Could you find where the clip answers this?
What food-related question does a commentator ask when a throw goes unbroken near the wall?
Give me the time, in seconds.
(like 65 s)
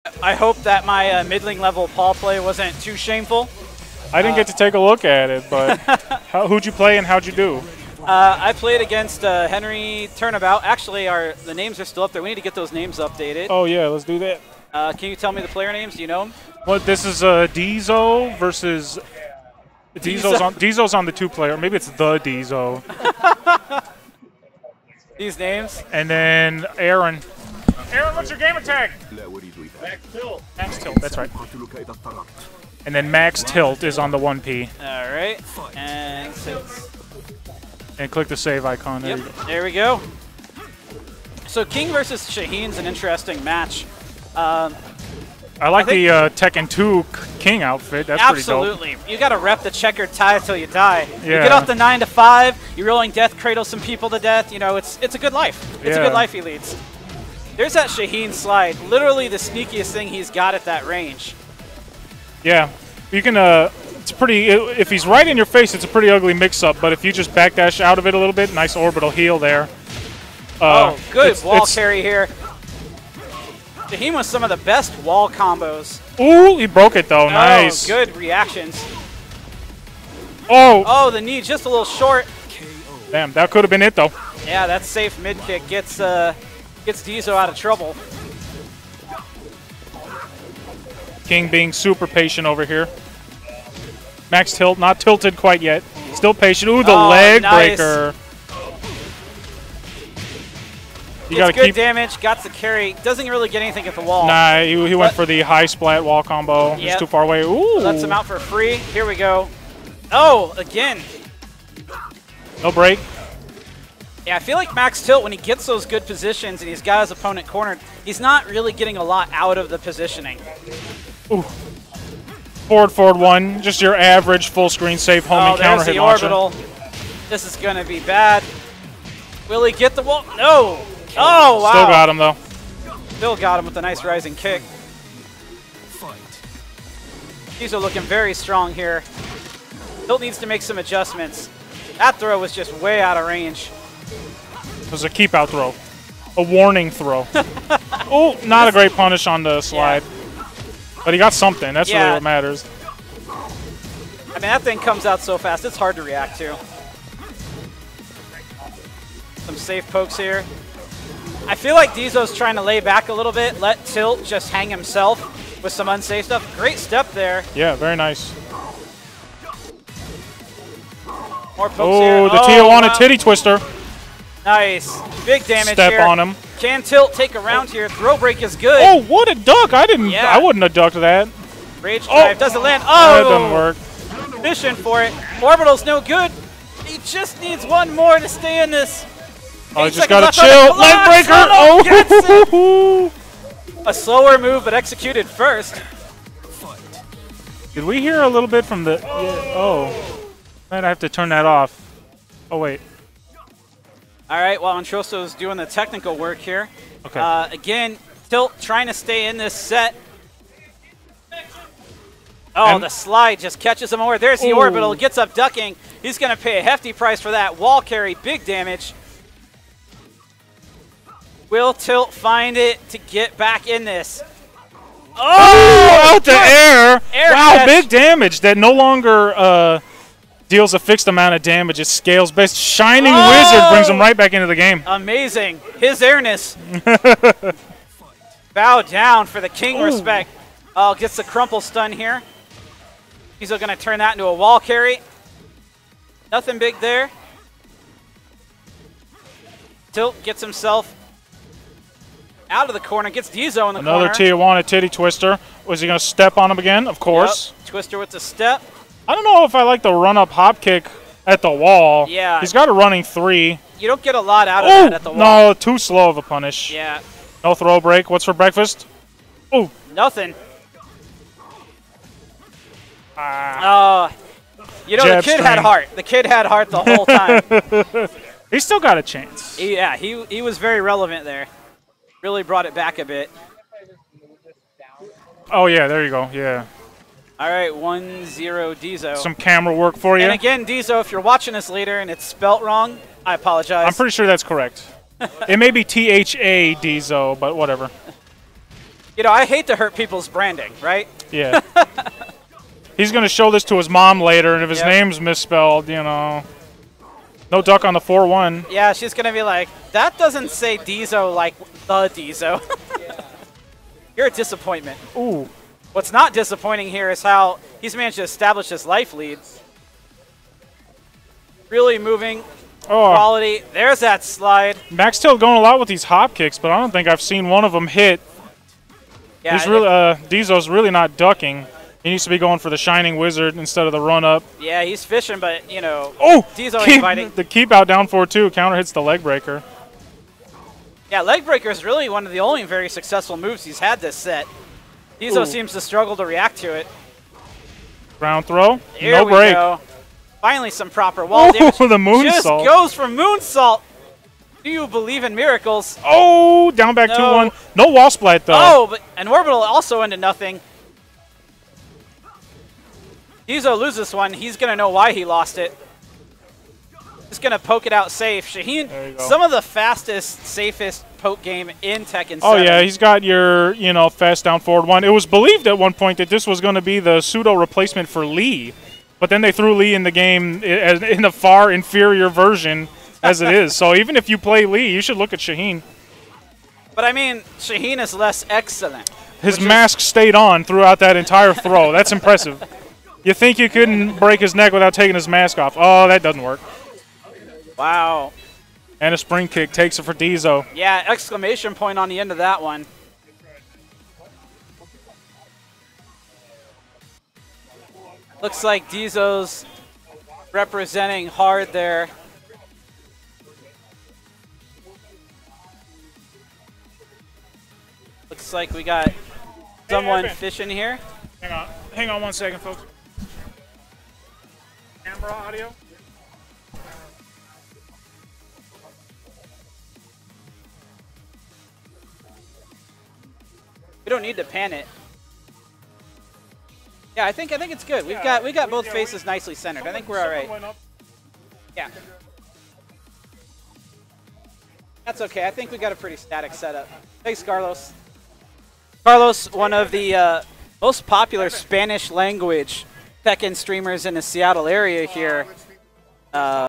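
268 s.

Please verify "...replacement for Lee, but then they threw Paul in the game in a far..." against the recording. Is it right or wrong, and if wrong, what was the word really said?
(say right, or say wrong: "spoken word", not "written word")
wrong: "Lee", not "Paul".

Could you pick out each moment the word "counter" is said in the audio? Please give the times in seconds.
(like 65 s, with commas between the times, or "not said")
125 s, 338 s.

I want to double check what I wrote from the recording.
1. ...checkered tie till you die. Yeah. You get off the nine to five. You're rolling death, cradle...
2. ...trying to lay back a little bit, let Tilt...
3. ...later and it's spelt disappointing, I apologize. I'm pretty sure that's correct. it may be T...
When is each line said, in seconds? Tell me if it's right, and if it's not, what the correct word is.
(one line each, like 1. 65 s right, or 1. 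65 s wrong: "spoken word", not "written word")
1. 49 s right
2. 162 s right
3. 291 s wrong: "wrong", not "disappointing".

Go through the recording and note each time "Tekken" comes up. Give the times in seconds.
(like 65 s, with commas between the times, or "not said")
46 s, 372 s, 453 s.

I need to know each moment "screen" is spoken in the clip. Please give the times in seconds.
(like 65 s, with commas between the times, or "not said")
124 s.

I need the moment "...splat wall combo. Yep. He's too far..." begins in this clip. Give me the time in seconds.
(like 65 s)
105 s.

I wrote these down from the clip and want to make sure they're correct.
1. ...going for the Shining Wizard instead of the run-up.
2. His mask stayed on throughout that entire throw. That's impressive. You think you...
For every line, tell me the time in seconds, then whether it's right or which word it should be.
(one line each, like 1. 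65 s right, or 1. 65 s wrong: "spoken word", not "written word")
1. 332 s right
2. 389 s right.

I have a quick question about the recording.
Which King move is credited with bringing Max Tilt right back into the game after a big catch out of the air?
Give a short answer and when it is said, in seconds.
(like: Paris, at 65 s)
Shining Wizard, at 232 s.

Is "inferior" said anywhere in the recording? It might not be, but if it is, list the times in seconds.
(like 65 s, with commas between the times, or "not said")
381 s.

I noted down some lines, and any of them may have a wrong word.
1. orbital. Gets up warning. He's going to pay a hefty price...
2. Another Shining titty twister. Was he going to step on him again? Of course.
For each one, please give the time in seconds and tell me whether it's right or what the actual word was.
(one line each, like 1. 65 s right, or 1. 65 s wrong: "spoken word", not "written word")
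1. 214 s wrong: "ducking", not "warning"
2. 254 s wrong: "Tijuana", not "Shining".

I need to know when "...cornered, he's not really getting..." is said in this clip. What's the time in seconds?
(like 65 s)
117 s.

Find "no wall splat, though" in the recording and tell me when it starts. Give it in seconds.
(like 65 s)
357 s.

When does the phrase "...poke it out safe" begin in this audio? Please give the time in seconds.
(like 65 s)
367 s.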